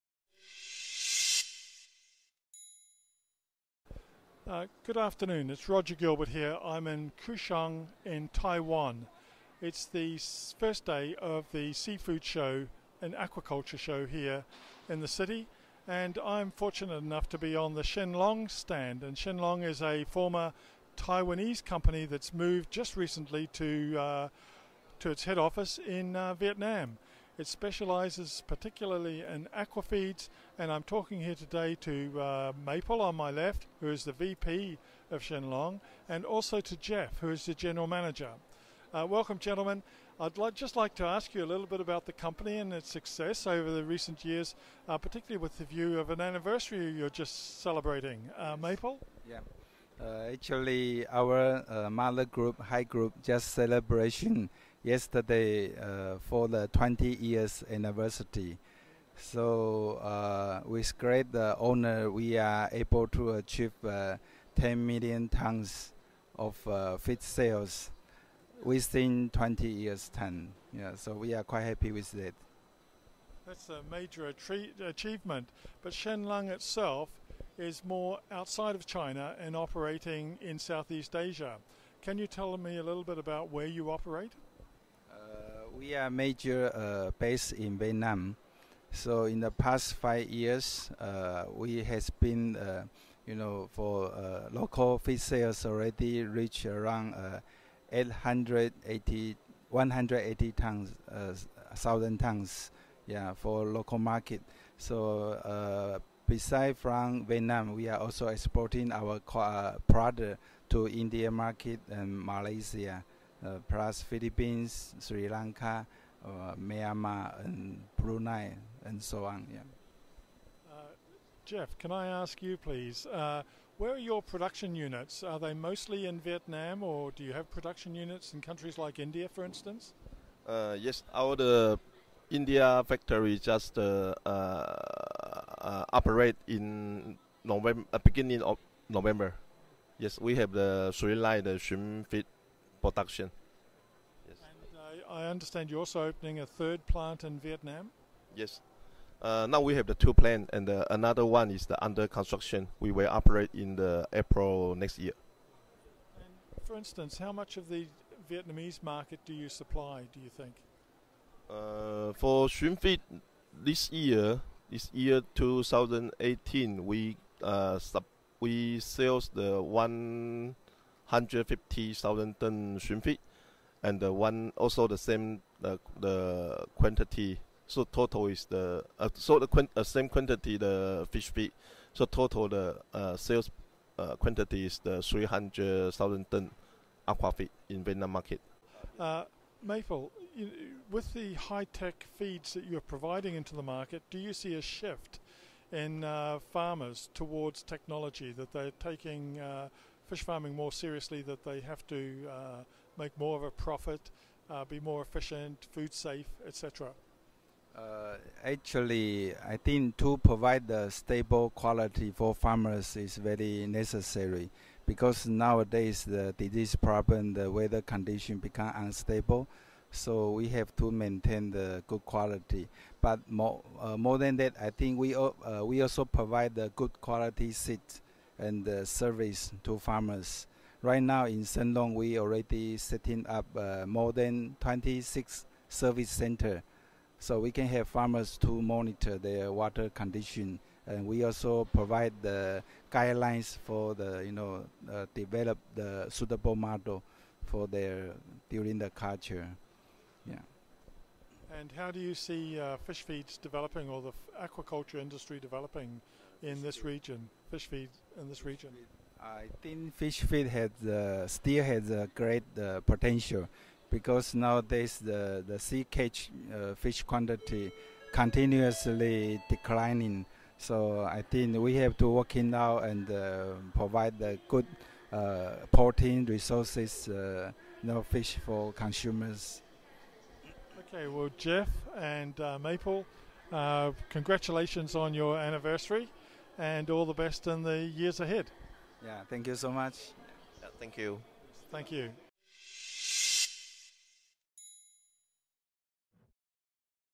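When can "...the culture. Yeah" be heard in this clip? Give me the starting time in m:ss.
4:08.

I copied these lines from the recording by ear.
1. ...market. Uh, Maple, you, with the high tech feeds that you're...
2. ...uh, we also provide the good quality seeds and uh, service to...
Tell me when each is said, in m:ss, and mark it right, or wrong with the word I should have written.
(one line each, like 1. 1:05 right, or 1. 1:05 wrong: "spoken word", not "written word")
1. 3:08 right
2. 3:45 right.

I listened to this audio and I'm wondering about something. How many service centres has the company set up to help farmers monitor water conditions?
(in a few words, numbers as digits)
more than 26.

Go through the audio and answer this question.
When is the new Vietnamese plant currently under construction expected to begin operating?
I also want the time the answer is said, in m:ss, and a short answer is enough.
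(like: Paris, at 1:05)
April next year, at 2:34.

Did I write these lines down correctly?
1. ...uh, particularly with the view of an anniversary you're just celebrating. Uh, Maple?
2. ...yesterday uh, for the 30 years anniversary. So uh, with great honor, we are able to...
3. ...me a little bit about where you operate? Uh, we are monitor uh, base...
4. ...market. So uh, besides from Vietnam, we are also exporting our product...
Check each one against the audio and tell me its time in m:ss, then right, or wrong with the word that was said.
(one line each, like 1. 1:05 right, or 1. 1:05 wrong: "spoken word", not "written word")
1. 0:44 right
2. 0:54 wrong: "20", not "30"
3. 1:22 wrong: "major", not "monitor"
4. 1:43 right.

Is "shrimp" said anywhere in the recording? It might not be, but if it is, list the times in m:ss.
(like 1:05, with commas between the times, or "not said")
2:21, 2:42, 2:52.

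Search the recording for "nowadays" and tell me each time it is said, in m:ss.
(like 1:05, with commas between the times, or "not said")
3:35, 4:24.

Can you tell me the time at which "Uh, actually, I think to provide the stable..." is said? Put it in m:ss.
3:27.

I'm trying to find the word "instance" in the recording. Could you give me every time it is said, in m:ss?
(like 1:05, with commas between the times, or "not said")
2:09, 2:36.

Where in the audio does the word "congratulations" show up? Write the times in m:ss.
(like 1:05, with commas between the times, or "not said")
4:44.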